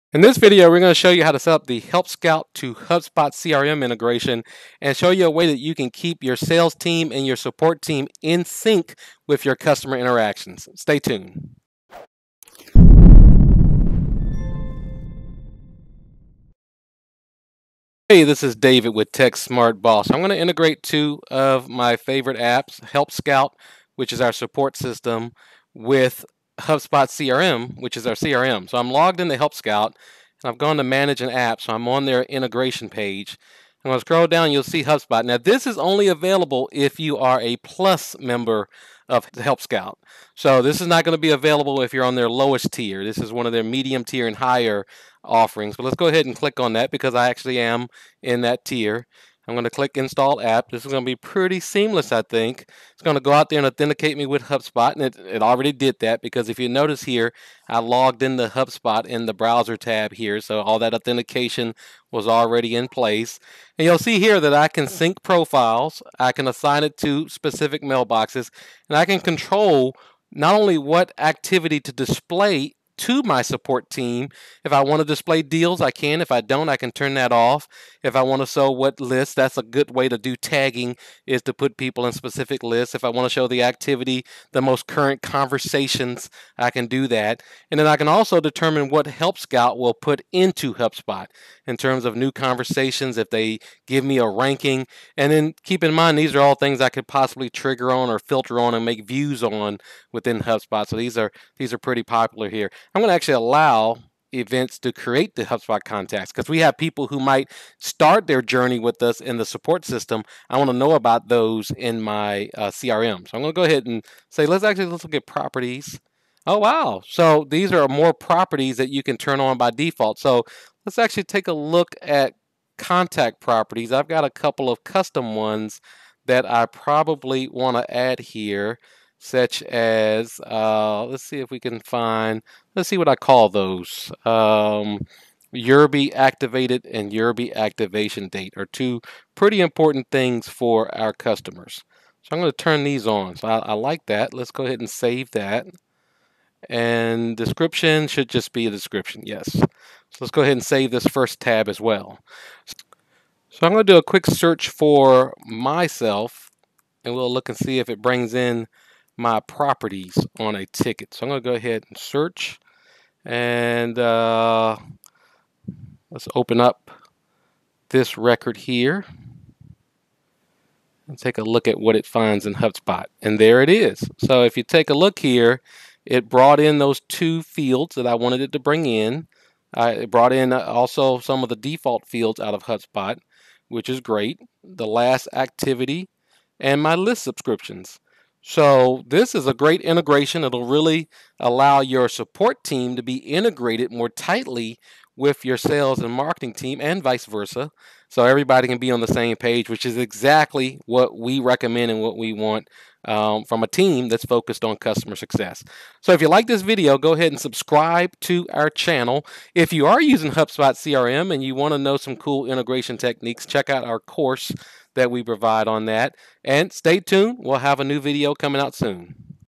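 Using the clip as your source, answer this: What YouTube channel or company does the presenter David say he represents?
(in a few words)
Tech Smart Boss.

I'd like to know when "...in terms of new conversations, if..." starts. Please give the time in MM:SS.
01:31.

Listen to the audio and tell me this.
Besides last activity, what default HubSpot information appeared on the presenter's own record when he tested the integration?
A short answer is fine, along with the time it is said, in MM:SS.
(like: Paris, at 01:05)
List subscriptions, at 03:06.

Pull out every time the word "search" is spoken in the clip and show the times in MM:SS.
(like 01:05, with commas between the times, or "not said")
02:34, 02:41.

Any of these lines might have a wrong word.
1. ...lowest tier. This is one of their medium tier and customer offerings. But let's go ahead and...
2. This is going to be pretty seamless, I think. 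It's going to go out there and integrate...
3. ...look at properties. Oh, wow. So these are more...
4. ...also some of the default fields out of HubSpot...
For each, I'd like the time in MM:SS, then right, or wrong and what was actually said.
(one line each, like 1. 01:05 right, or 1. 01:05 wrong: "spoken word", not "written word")
1. 00:42 wrong: "higher", not "customer"
2. 00:50 wrong: "authenticate", not "integrate"
3. 01:55 right
4. 03:00 right.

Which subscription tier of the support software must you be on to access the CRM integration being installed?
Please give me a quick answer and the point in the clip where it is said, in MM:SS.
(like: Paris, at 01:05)
Plus, at 00:37.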